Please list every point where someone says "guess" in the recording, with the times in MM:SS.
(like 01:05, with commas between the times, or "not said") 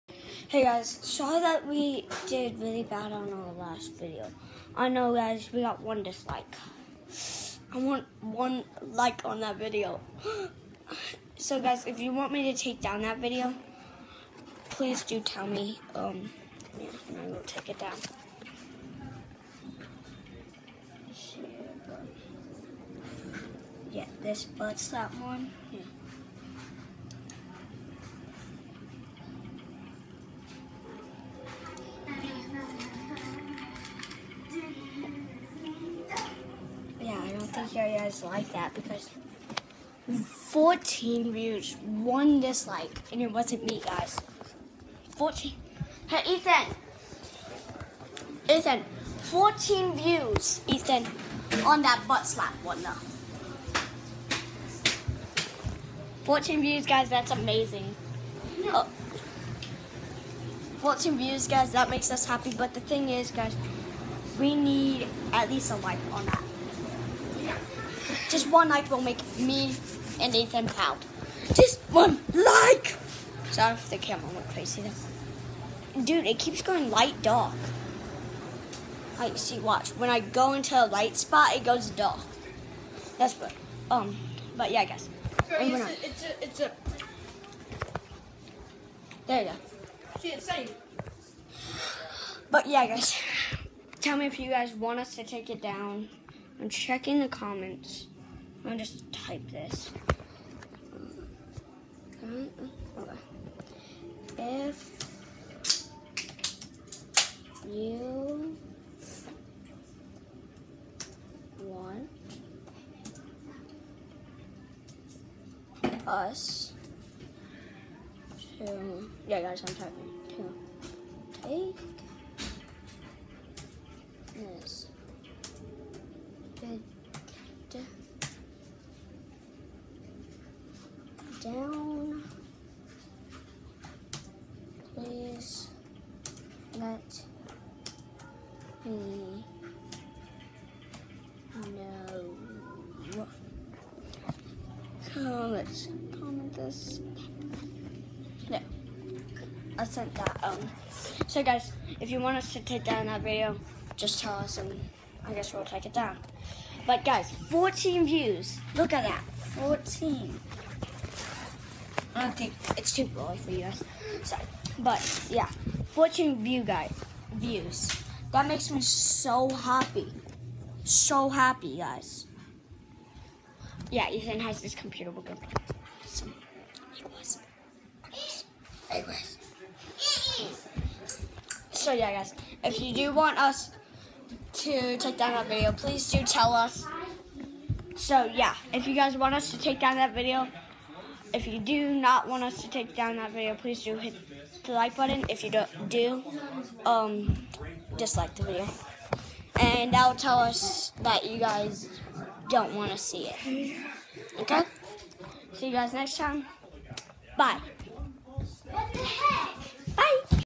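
01:24, 02:35.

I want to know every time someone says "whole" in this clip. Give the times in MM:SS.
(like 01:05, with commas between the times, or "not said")
not said.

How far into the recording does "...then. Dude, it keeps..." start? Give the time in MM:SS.
01:14.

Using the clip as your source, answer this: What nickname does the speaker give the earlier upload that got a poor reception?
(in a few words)
butt slap.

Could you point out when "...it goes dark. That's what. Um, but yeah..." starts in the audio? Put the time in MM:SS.
01:21.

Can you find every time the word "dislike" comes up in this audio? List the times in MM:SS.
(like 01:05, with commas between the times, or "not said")
00:06, 00:42, 03:17.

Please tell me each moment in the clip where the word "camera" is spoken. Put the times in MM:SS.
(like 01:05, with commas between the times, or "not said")
01:13.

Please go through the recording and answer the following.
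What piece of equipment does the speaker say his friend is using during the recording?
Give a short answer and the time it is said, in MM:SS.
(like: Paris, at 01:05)
computer, at 02:54.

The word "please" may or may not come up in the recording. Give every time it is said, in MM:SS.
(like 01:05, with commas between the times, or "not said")
00:14, 03:05, 03:13.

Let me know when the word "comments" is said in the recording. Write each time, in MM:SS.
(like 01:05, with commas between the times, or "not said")
01:37, 02:26.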